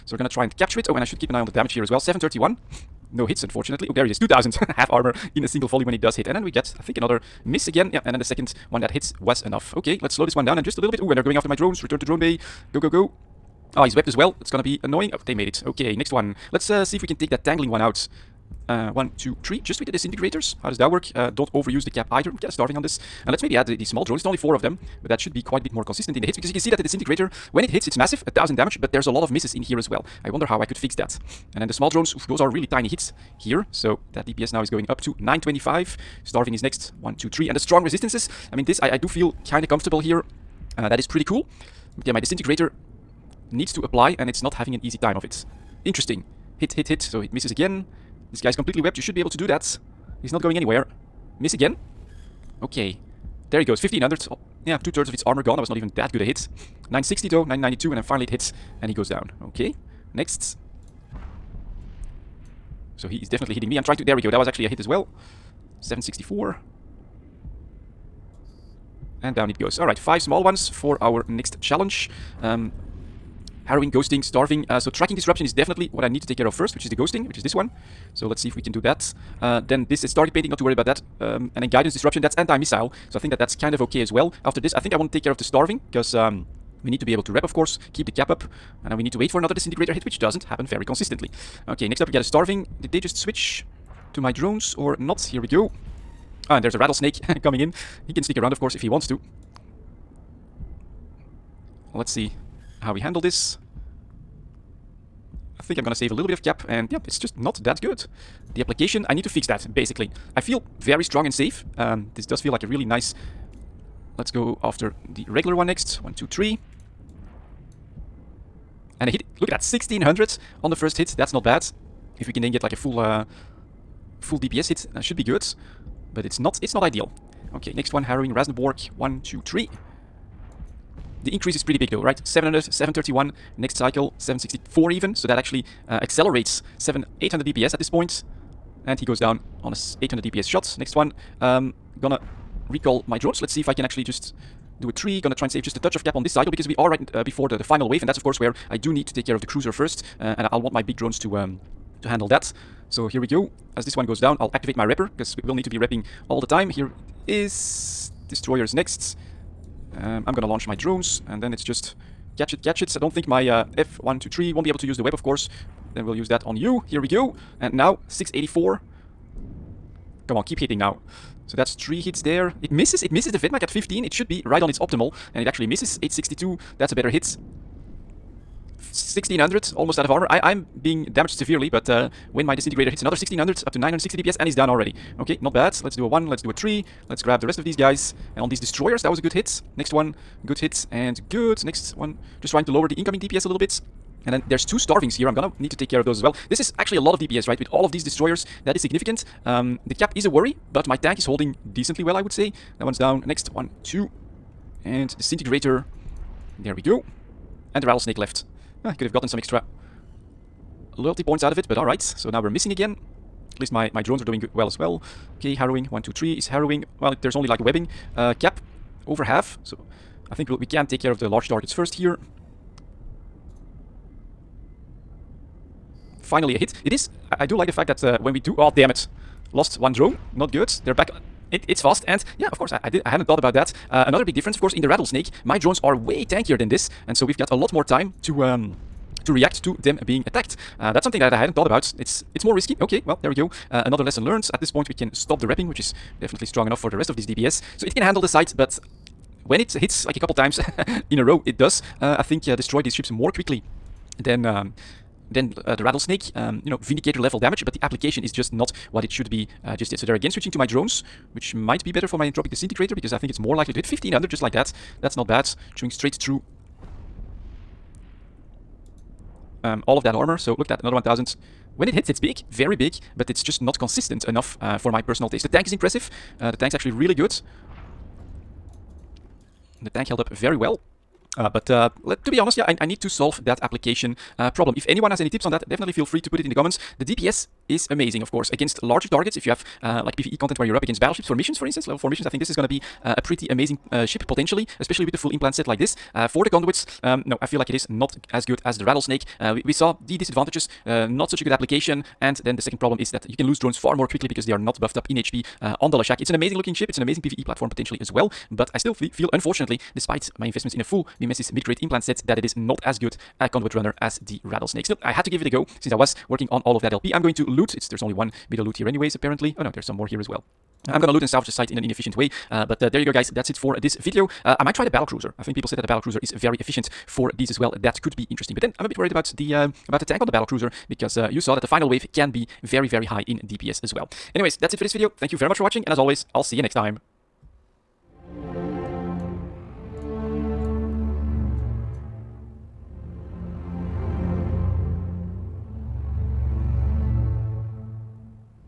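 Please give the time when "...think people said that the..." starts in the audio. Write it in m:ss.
5:25.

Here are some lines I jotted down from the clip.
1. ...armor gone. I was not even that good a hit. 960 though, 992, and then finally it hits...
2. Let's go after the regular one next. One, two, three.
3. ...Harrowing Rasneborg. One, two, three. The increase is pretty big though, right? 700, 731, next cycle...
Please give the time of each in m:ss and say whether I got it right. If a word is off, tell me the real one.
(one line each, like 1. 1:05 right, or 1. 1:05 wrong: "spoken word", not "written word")
1. 0:55 right
2. 1:54 right
3. 2:08 right.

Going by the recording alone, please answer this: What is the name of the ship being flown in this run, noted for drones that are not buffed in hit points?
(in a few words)
Leshak.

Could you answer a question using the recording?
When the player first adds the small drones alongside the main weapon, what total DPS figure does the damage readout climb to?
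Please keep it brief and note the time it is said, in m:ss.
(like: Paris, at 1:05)
925, at 0:35.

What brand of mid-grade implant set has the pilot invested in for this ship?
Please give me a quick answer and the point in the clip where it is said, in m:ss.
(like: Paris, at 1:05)
Mimesis, at 5:11.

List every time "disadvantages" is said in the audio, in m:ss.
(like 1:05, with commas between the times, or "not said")
5:00.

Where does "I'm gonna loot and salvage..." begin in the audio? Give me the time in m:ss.
5:20.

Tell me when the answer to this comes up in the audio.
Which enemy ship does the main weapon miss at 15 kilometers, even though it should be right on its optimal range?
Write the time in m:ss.
2:53.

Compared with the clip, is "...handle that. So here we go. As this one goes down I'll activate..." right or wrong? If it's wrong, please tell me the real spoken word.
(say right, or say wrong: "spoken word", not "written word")
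right.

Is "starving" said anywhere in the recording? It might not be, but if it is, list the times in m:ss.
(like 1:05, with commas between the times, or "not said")
0:22, 0:36, 1:14, 1:25, 1:32, 3:14.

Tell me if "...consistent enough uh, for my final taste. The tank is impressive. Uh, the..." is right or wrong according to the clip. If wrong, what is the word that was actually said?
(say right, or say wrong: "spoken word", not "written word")
wrong: "personal", not "final".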